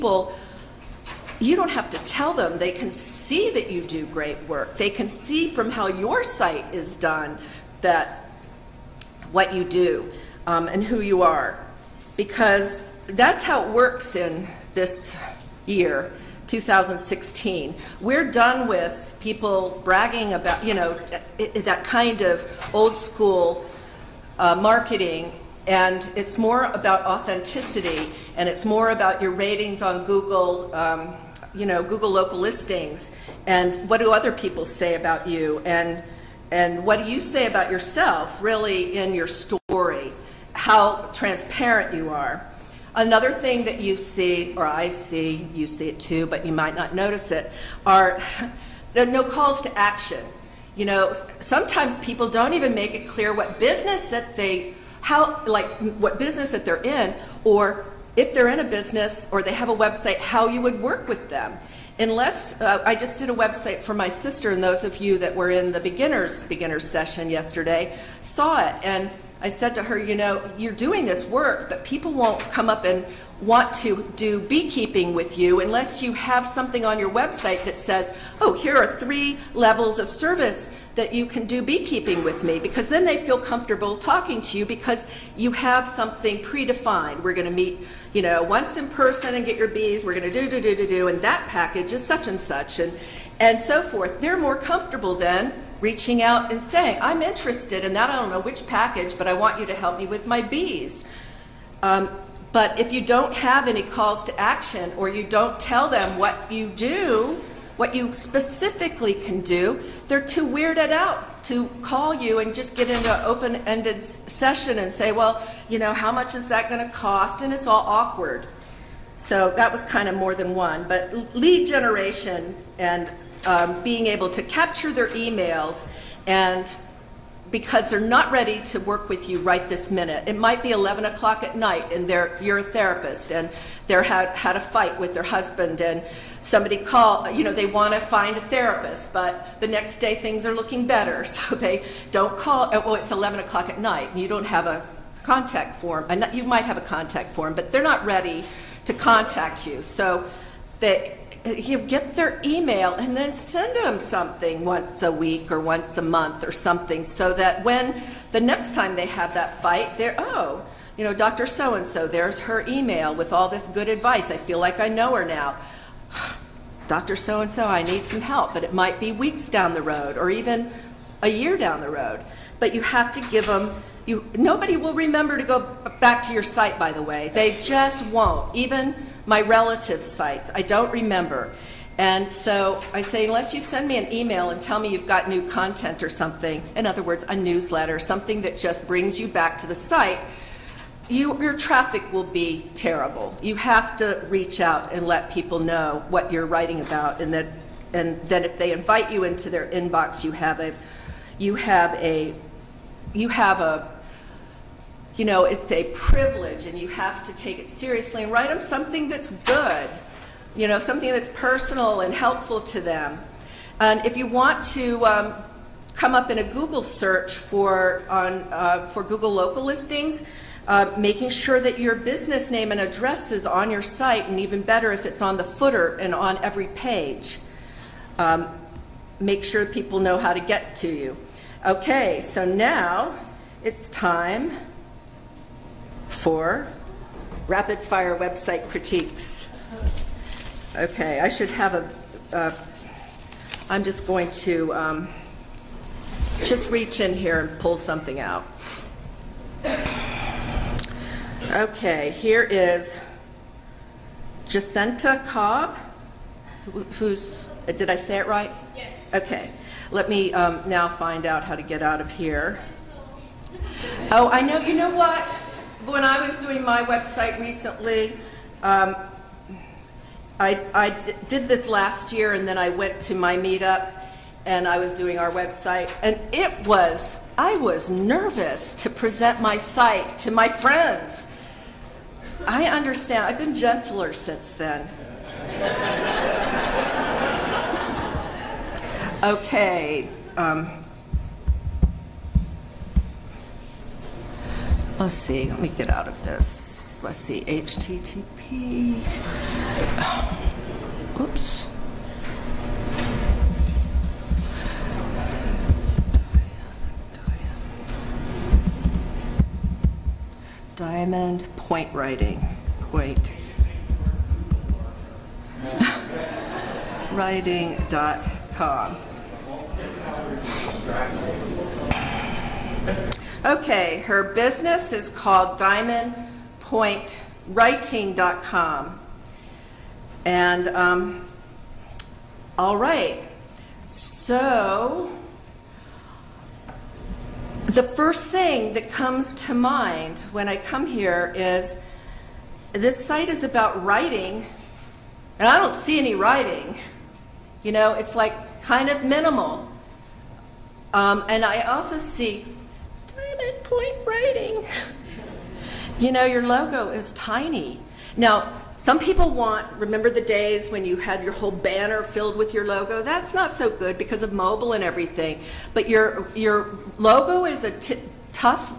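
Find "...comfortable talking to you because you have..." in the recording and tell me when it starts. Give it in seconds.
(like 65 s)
83 s.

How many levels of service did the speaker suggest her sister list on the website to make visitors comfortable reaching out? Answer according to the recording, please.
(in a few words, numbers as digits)
3.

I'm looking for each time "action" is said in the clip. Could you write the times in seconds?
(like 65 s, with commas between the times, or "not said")
49 s, 104 s.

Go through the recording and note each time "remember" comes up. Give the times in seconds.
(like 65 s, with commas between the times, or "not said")
174 s, 180 s, 359 s.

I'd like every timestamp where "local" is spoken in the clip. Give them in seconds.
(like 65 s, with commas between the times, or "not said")
32 s, 219 s.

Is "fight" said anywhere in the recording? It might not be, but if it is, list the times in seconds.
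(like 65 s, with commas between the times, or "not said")
134 s, 159 s.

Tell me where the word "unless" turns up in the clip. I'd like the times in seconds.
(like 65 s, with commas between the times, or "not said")
61 s, 75 s, 183 s.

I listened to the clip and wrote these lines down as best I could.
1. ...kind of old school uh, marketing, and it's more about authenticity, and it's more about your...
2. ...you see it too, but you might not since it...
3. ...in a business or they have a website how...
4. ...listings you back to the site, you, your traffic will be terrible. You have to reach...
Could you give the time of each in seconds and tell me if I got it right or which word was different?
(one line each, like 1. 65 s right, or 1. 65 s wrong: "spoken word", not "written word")
1. 21 s right
2. 45 s wrong: "notice", not "since"
3. 58 s right
4. 188 s wrong: "brings", not "listings".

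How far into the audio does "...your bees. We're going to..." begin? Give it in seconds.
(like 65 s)
89 s.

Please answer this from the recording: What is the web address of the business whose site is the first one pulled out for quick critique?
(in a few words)
diamondpointwriting.com.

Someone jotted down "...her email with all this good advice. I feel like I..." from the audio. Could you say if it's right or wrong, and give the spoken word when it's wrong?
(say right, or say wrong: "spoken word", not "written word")
right.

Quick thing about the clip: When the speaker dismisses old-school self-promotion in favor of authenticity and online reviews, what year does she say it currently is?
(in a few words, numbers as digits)
2016.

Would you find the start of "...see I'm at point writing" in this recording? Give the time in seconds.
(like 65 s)
351 s.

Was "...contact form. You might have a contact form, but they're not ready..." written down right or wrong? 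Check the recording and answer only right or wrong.
right.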